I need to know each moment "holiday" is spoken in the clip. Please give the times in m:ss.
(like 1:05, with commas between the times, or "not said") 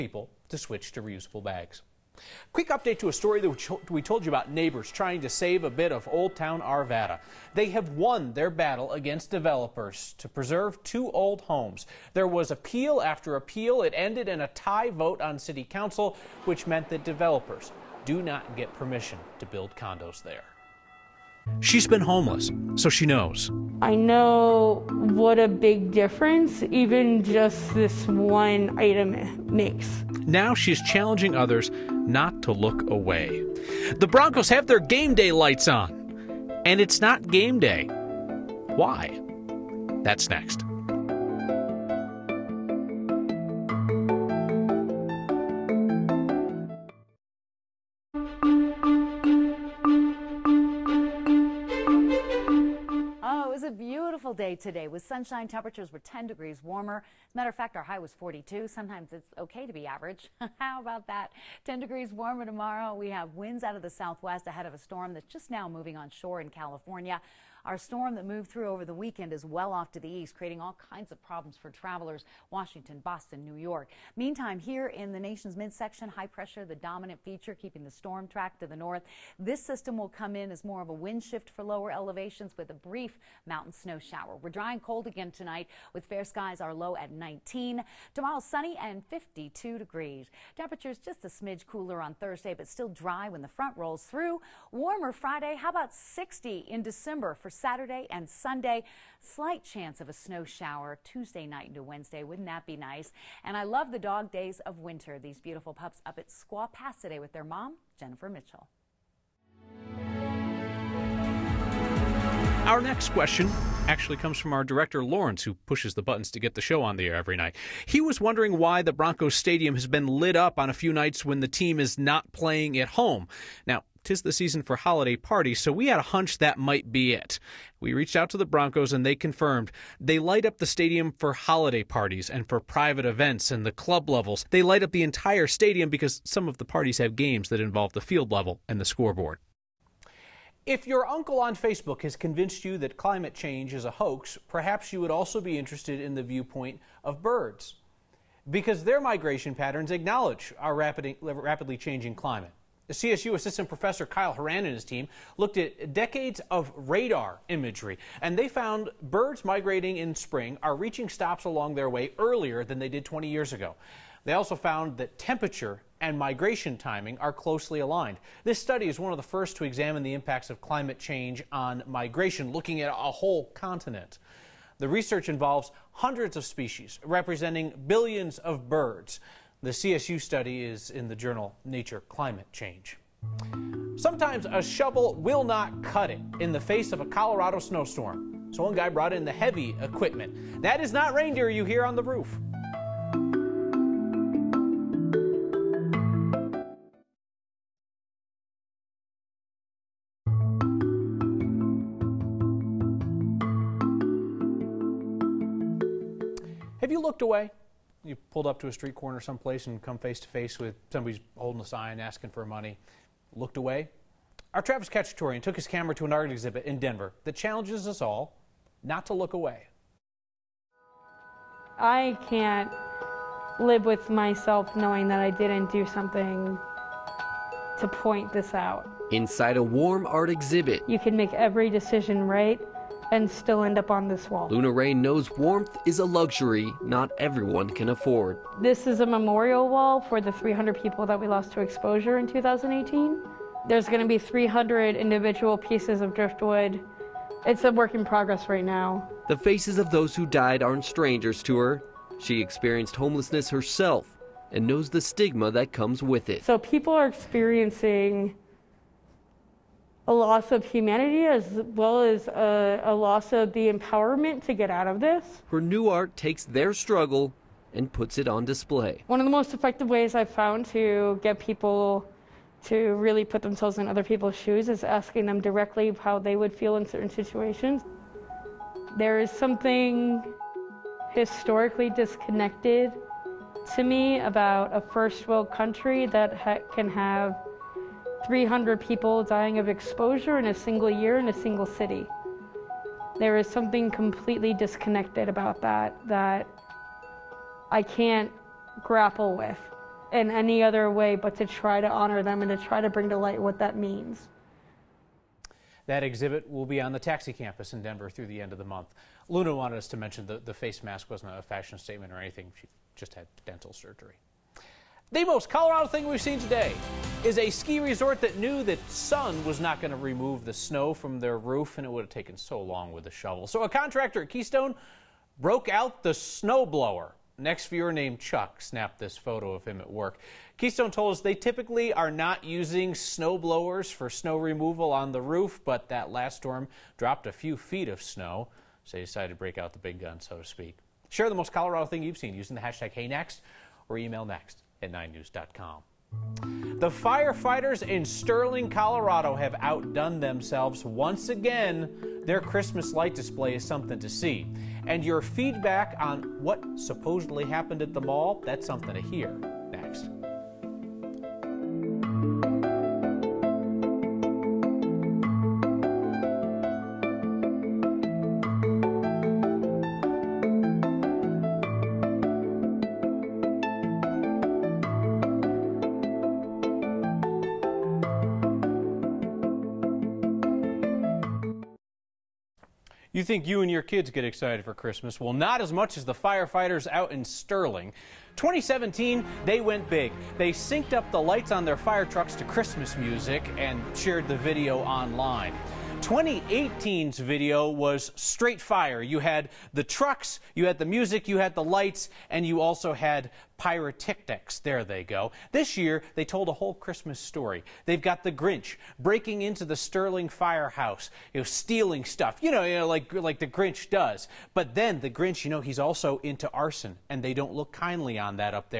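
2:04, 2:11.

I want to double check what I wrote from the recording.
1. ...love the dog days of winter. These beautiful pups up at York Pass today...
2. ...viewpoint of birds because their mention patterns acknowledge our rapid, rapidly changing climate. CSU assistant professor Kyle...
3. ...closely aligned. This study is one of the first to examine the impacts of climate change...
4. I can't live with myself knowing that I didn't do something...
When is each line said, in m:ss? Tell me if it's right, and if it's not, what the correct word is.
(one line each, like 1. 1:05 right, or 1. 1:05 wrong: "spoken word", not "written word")
1. 1:43 wrong: "Squaw", not "York"
2. 2:26 wrong: "migration", not "mention"
3. 2:47 right
4. 3:41 right.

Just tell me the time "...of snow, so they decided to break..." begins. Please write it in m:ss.
5:37.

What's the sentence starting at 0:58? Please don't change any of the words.
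Sometimes it's okay to be average.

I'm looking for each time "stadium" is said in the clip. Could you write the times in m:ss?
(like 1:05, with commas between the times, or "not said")
1:59, 2:10, 2:15.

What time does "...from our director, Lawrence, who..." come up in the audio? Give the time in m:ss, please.
1:54.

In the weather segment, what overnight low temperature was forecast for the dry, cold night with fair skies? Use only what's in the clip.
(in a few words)
19.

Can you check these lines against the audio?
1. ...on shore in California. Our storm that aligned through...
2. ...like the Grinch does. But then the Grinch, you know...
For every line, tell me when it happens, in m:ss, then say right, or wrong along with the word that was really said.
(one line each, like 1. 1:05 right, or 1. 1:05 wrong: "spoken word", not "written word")
1. 1:05 wrong: "moved", not "aligned"
2. 6:53 right.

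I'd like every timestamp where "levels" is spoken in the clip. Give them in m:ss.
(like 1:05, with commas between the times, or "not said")
2:14, 2:18.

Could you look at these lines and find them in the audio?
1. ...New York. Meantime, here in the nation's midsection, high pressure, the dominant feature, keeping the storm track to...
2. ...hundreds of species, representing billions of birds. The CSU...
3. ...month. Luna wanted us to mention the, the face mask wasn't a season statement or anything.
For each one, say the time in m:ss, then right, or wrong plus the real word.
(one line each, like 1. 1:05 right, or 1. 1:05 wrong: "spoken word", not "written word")
1. 1:13 right
2. 2:55 right
3. 5:08 wrong: "fashion", not "season".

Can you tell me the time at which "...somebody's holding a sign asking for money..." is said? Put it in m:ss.
3:30.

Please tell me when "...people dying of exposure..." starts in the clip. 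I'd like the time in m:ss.
4:48.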